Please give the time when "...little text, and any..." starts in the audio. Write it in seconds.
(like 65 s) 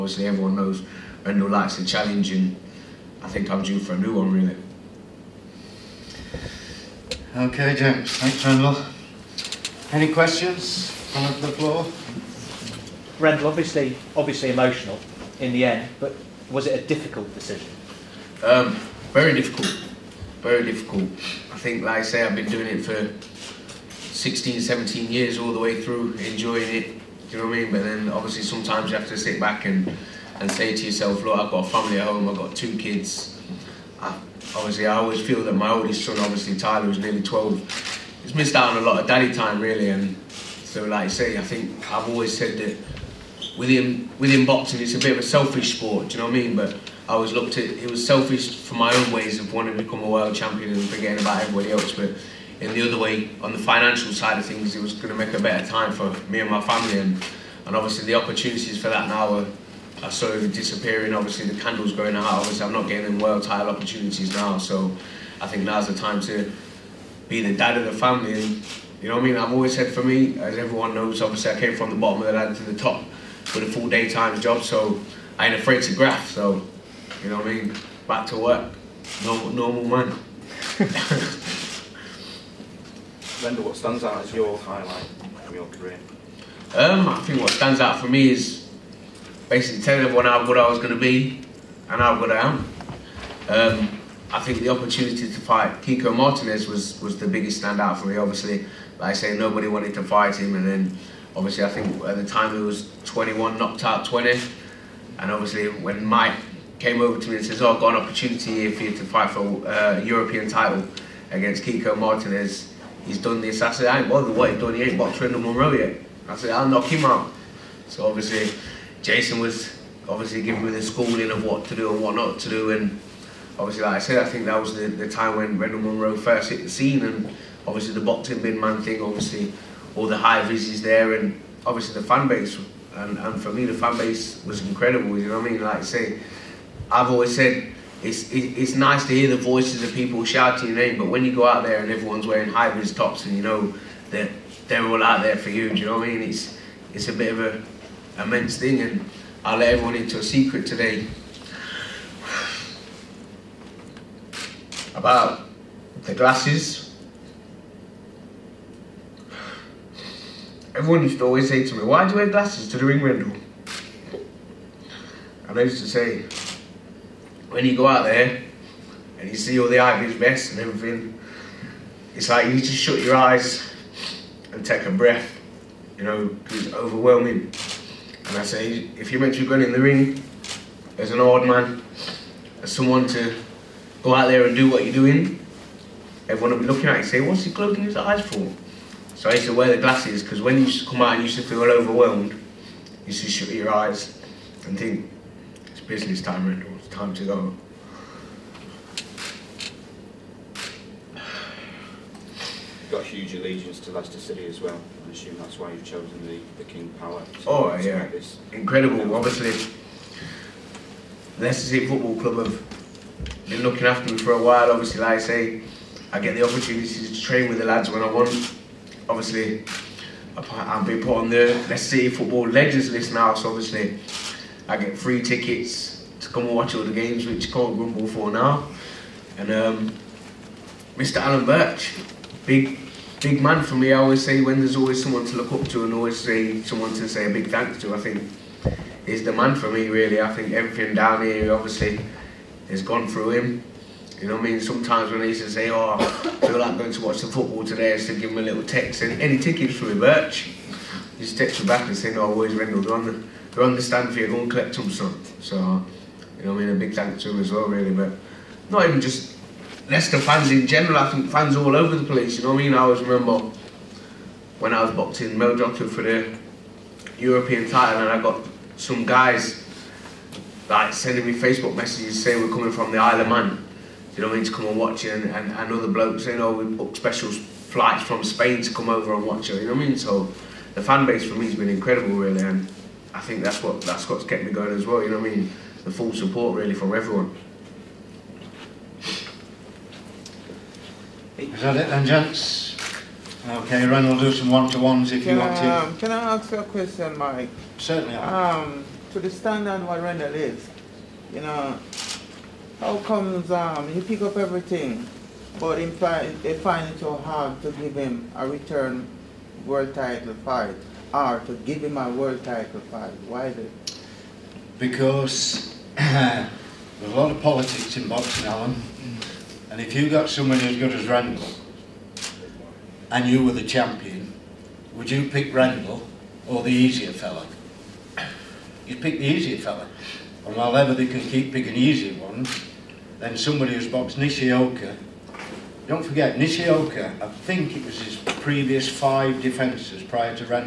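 248 s.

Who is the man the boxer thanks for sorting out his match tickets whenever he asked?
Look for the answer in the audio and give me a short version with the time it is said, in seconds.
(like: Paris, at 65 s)
Alan Birch, at 231 s.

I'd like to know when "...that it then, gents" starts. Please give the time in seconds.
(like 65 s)
291 s.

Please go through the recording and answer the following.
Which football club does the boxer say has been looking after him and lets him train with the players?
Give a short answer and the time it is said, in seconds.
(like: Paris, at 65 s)
Leicester City Football Club, at 211 s.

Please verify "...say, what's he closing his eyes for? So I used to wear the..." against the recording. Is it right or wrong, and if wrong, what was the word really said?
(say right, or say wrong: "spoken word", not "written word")
right.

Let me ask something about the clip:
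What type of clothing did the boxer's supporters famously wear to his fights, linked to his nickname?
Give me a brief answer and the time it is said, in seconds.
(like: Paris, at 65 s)
High vis tops, at 142 s.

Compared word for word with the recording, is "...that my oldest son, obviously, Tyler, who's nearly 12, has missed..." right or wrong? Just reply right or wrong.
right.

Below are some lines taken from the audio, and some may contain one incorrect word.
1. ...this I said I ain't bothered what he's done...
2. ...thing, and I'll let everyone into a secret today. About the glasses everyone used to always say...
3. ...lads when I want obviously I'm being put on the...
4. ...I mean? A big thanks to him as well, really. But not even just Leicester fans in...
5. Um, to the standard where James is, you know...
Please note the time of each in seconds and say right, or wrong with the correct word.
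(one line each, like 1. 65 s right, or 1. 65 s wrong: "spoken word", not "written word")
1. 113 s right
2. 148 s right
3. 217 s right
4. 256 s right
5. 298 s wrong: "Randall", not "James".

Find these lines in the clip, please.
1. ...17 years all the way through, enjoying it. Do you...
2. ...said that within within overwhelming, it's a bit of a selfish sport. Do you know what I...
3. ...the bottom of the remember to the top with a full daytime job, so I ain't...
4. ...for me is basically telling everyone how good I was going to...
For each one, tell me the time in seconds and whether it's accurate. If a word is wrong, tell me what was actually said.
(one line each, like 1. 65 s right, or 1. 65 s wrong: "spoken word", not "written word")
1. 24 s right
2. 42 s wrong: "boxing", not "overwhelming"
3. 71 s wrong: "ladder", not "remember"
4. 87 s right.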